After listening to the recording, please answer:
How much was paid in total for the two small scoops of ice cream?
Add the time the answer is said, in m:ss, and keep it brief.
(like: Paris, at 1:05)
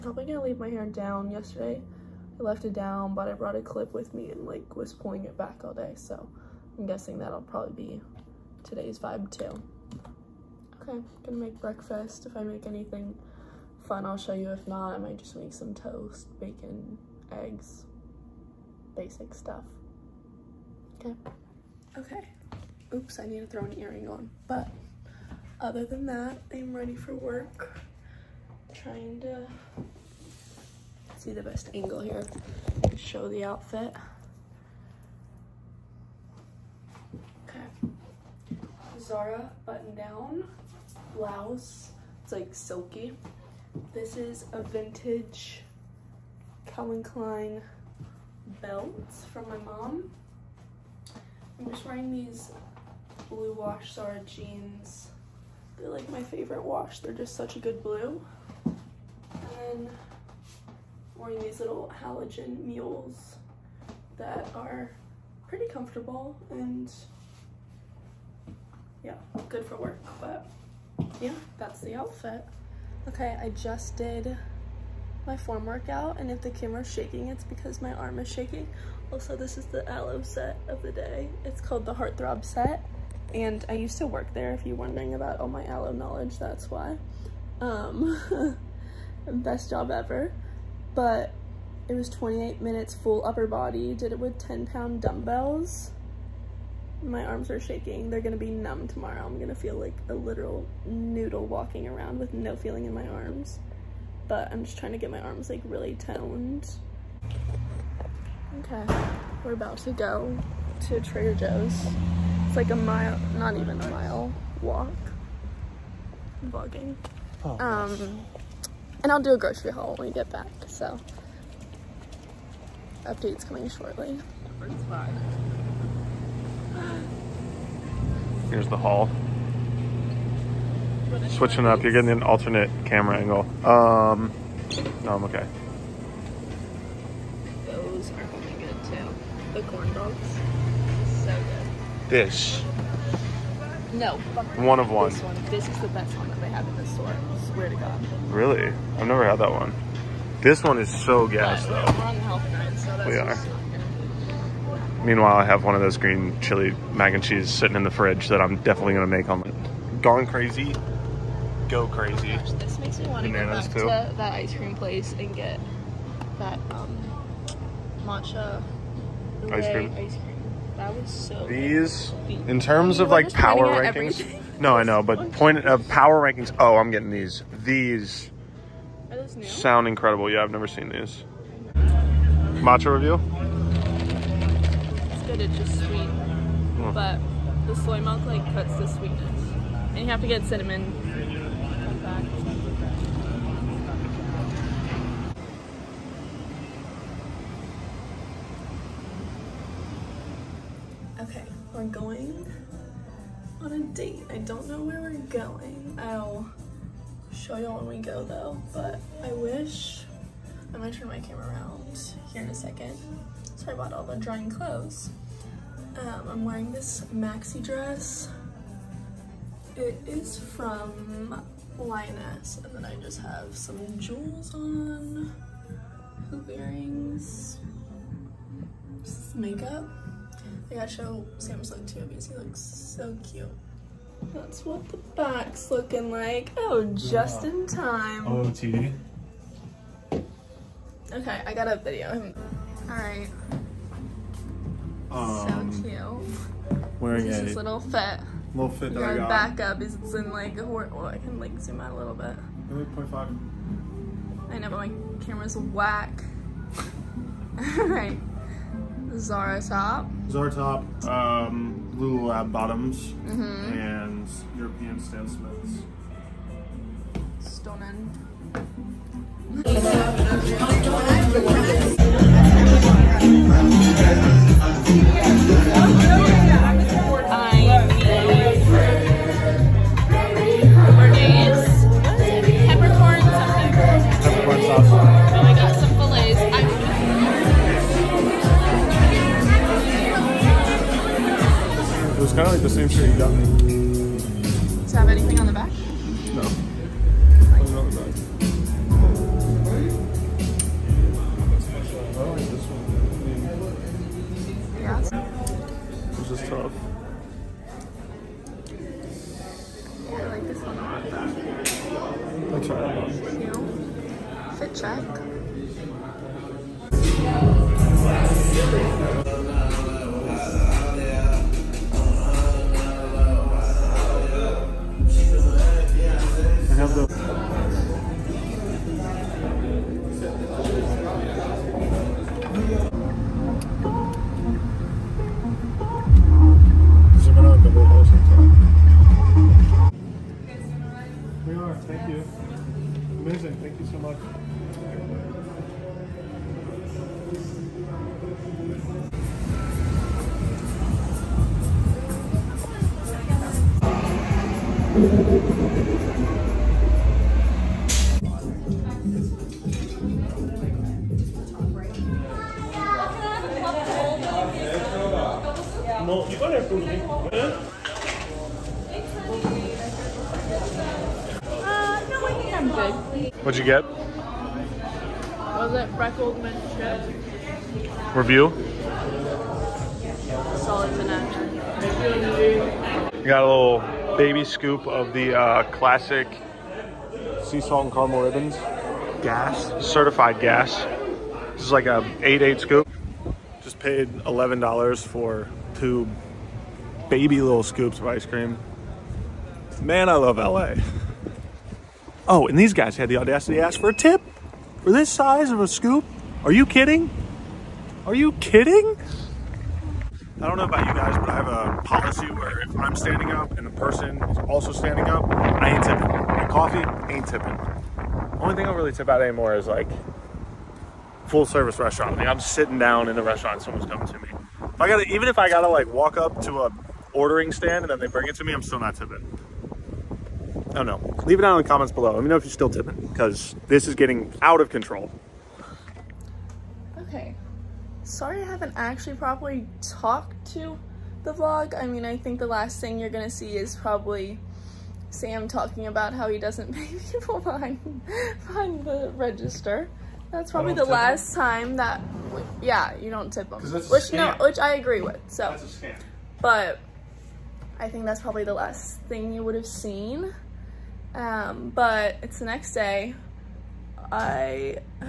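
$11, at 6:34.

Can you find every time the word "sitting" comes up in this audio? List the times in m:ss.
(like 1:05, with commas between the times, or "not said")
2:37, 7:02.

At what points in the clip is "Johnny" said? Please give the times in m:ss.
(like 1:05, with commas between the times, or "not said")
not said.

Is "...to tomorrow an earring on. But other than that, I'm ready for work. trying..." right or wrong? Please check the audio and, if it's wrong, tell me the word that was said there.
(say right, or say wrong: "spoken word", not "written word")
wrong: "throw", not "tomorrow".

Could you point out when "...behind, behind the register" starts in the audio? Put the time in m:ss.
7:27.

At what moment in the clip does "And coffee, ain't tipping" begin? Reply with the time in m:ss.
6:56.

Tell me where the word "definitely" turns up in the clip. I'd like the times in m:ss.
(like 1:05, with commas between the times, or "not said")
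2:38.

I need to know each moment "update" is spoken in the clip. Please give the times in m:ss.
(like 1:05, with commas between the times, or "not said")
2:03.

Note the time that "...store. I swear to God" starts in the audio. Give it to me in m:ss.
2:26.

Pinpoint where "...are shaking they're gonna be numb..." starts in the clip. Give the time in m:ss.
1:37.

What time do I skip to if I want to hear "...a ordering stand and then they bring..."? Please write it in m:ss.
7:06.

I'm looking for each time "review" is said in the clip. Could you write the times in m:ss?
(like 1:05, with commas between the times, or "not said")
3:02, 6:18.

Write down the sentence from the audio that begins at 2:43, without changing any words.
to that ice cream place and get that um, matcha ice cream.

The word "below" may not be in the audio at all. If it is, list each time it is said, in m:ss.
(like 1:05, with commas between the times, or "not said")
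7:11.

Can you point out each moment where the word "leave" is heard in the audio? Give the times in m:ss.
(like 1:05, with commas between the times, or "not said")
0:00, 7:11.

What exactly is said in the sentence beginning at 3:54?
That's what the back's looking like.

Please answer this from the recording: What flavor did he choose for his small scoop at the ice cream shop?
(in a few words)
Sea salt and caramel ribbons.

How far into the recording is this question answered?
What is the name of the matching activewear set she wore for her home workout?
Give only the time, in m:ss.
1:21.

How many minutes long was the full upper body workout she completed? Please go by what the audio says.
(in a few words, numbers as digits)
28.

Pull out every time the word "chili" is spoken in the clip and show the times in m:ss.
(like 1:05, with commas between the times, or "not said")
2:36.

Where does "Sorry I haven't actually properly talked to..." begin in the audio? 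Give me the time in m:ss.
7:18.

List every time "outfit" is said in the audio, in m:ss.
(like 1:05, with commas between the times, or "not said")
0:33, 1:11.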